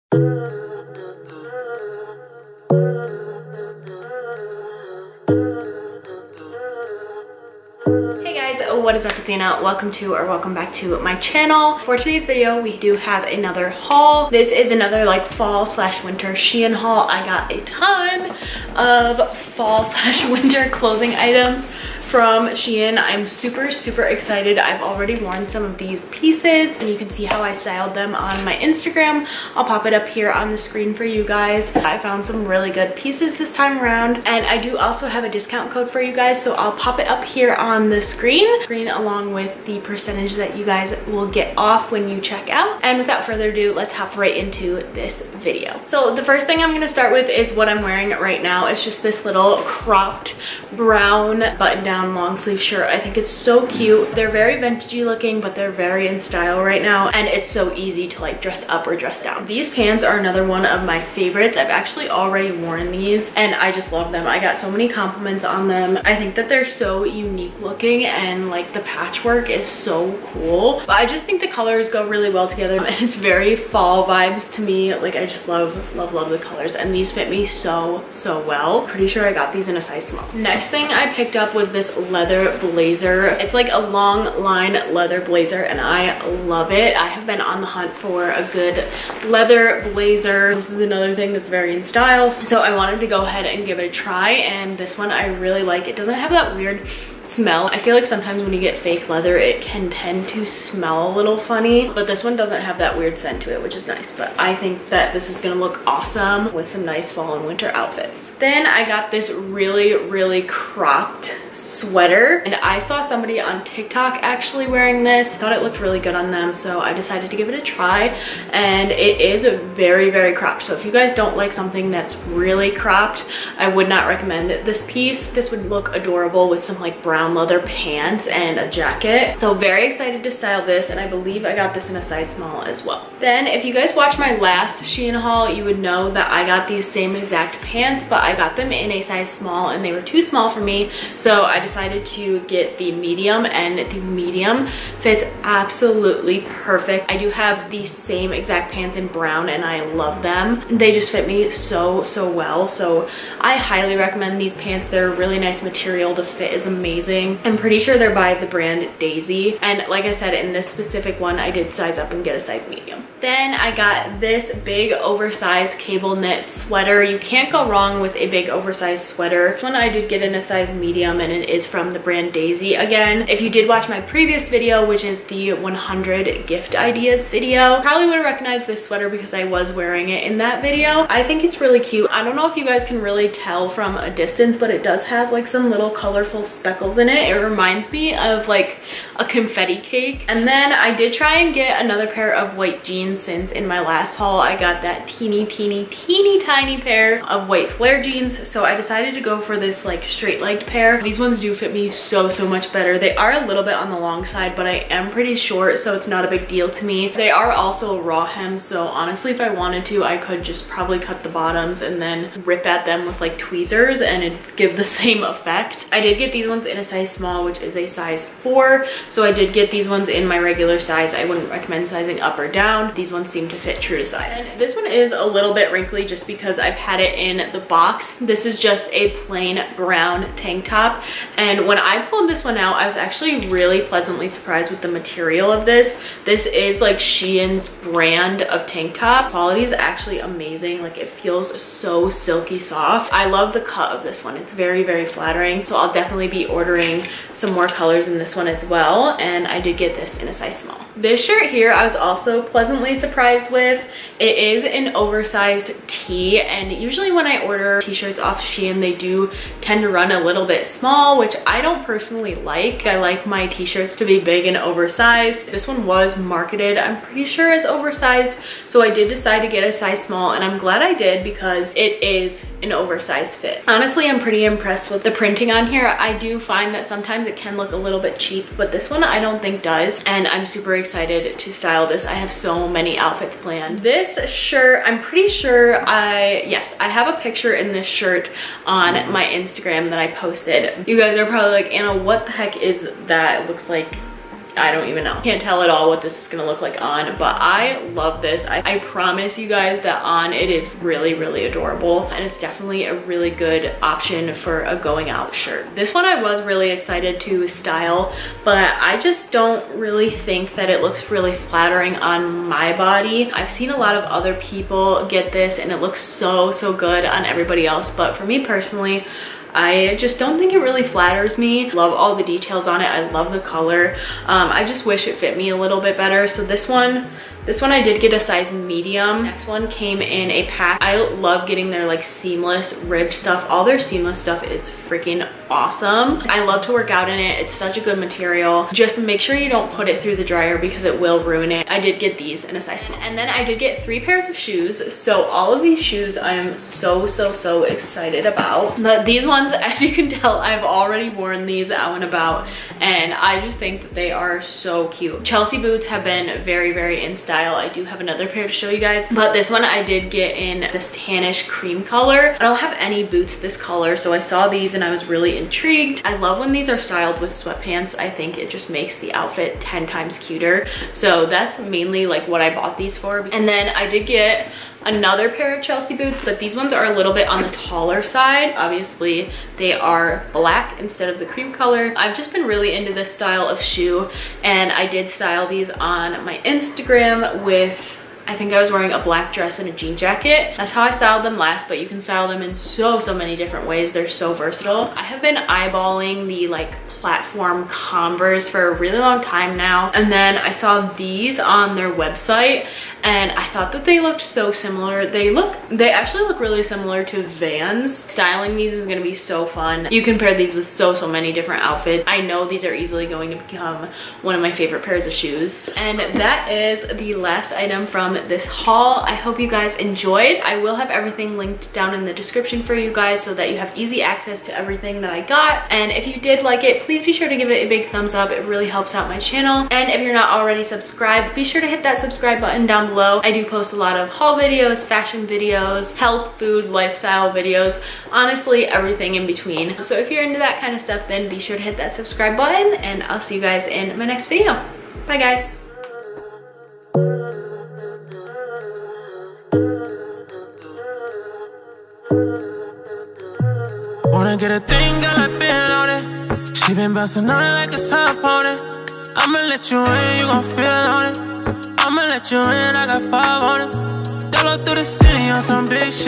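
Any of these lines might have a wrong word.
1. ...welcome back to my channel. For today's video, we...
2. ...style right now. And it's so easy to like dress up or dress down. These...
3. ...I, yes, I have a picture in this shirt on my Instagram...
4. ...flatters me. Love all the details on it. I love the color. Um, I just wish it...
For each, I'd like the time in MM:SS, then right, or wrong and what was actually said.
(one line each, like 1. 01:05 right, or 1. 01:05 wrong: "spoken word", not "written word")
1. 00:10 right
2. 00:56 right
3. 04:45 right
4. 05:20 right.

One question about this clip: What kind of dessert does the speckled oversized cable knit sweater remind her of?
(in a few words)
confetti cake.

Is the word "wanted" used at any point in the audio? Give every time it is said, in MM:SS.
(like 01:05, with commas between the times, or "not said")
01:32, 03:29.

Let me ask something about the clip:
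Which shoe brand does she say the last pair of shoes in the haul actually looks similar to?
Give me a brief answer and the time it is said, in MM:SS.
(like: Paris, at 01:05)
Vans, at 06:47.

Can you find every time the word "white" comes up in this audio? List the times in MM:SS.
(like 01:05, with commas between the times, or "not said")
03:12, 03:17.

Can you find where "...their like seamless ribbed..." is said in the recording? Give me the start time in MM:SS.
05:31.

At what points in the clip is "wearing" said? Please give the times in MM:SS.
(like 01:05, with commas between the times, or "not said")
00:47, 01:54, 02:59, 06:28.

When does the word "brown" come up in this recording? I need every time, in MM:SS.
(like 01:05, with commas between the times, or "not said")
00:50, 02:07, 02:29, 03:49.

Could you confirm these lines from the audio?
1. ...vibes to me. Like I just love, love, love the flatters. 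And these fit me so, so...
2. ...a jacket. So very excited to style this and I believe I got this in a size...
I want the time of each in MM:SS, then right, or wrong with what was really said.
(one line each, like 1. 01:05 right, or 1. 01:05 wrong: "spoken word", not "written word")
1. 01:14 wrong: "colors", not "flatters"
2. 02:08 right.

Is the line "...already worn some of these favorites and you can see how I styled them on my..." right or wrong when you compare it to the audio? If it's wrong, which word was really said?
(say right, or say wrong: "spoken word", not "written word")
wrong: "pieces", not "favorites".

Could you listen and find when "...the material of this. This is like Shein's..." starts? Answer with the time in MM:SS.
03:54.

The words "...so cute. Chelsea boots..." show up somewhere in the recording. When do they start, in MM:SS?
05:54.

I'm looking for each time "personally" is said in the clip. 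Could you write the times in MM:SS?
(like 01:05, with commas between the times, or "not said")
04:21, 05:18.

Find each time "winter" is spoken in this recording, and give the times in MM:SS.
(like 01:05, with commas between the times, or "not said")
00:16, 00:20, 01:47.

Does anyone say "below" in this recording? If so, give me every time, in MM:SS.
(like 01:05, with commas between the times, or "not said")
07:12.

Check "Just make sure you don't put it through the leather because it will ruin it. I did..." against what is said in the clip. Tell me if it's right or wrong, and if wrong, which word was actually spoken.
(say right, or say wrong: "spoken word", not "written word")
wrong: "dryer", not "leather".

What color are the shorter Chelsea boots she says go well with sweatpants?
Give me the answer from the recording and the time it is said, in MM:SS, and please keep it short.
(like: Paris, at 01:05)
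tannish cream, at 06:00.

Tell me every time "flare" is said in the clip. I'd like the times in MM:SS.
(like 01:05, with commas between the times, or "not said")
03:17.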